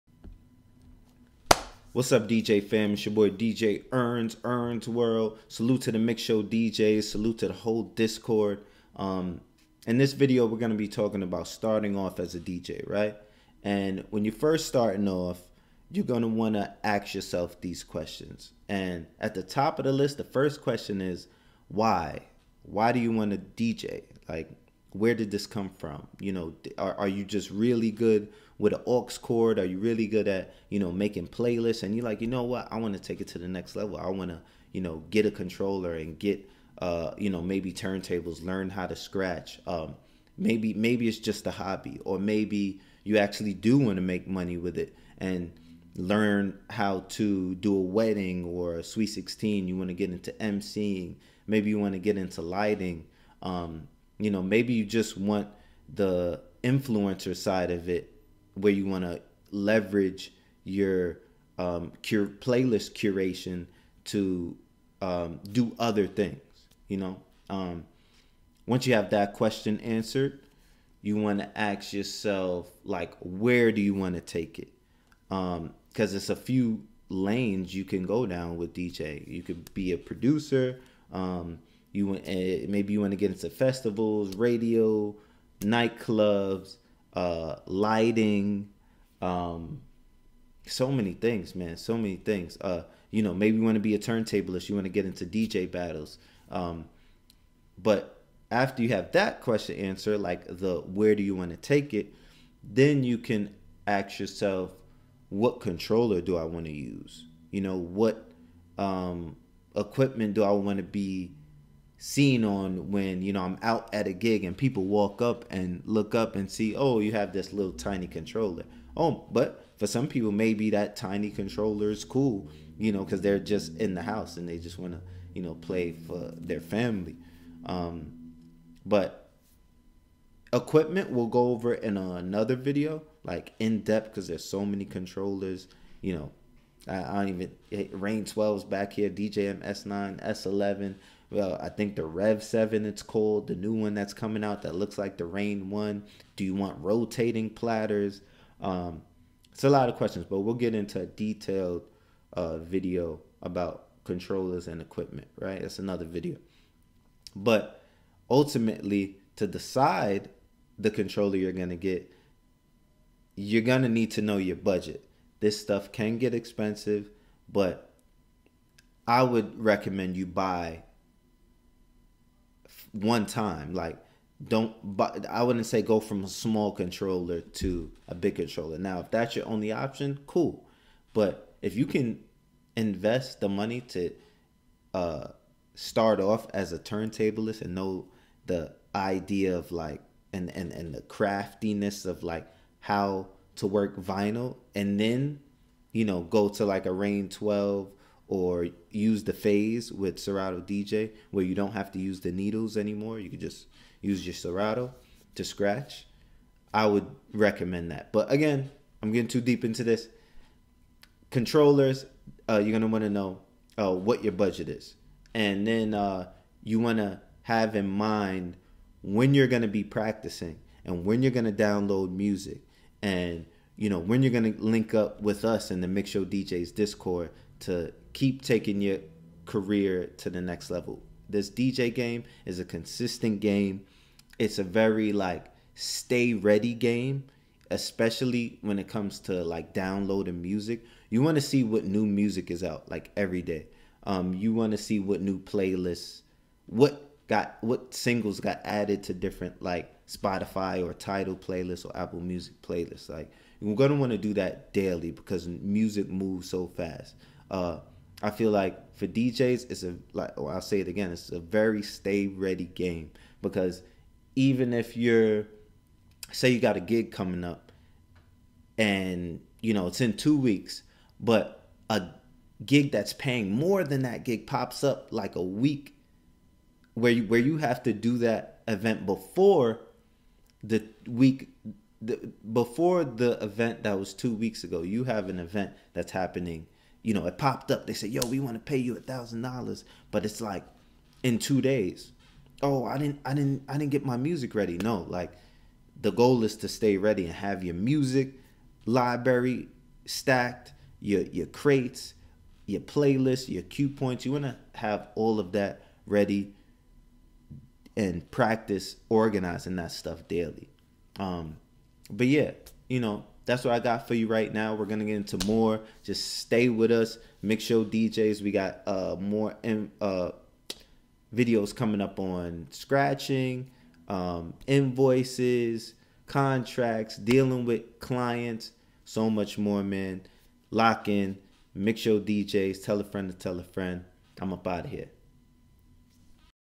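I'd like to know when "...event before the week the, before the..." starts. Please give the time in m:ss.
4:38.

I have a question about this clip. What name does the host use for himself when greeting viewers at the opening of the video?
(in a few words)
DJ Earns.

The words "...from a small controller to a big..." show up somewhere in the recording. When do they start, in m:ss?
2:55.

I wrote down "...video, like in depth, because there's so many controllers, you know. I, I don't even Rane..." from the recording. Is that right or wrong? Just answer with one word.
right.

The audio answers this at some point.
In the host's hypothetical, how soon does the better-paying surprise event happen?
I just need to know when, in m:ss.
4:51.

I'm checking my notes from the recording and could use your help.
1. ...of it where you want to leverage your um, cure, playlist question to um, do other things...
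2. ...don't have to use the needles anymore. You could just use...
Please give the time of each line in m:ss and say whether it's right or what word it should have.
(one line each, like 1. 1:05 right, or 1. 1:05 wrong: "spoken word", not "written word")
1. 0:57 wrong: "curation", not "question"
2. 3:21 right.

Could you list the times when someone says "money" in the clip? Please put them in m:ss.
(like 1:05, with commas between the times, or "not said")
0:44, 3:03.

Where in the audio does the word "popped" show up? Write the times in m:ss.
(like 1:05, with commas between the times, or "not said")
4:47.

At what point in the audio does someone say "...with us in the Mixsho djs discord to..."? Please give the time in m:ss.
3:45.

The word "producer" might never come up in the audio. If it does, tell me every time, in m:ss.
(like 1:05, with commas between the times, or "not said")
1:19.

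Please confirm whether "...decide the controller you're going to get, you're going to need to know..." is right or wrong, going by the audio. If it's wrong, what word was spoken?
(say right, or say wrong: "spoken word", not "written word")
right.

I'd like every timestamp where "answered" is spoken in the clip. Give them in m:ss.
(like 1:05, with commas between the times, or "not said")
1:09, 1:39.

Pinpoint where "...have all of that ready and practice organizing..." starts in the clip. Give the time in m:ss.
5:04.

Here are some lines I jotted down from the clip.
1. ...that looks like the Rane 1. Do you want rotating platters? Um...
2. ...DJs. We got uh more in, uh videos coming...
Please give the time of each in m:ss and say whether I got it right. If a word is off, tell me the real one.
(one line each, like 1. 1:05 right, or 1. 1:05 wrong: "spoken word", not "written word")
1. 2:24 right
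2. 5:17 right.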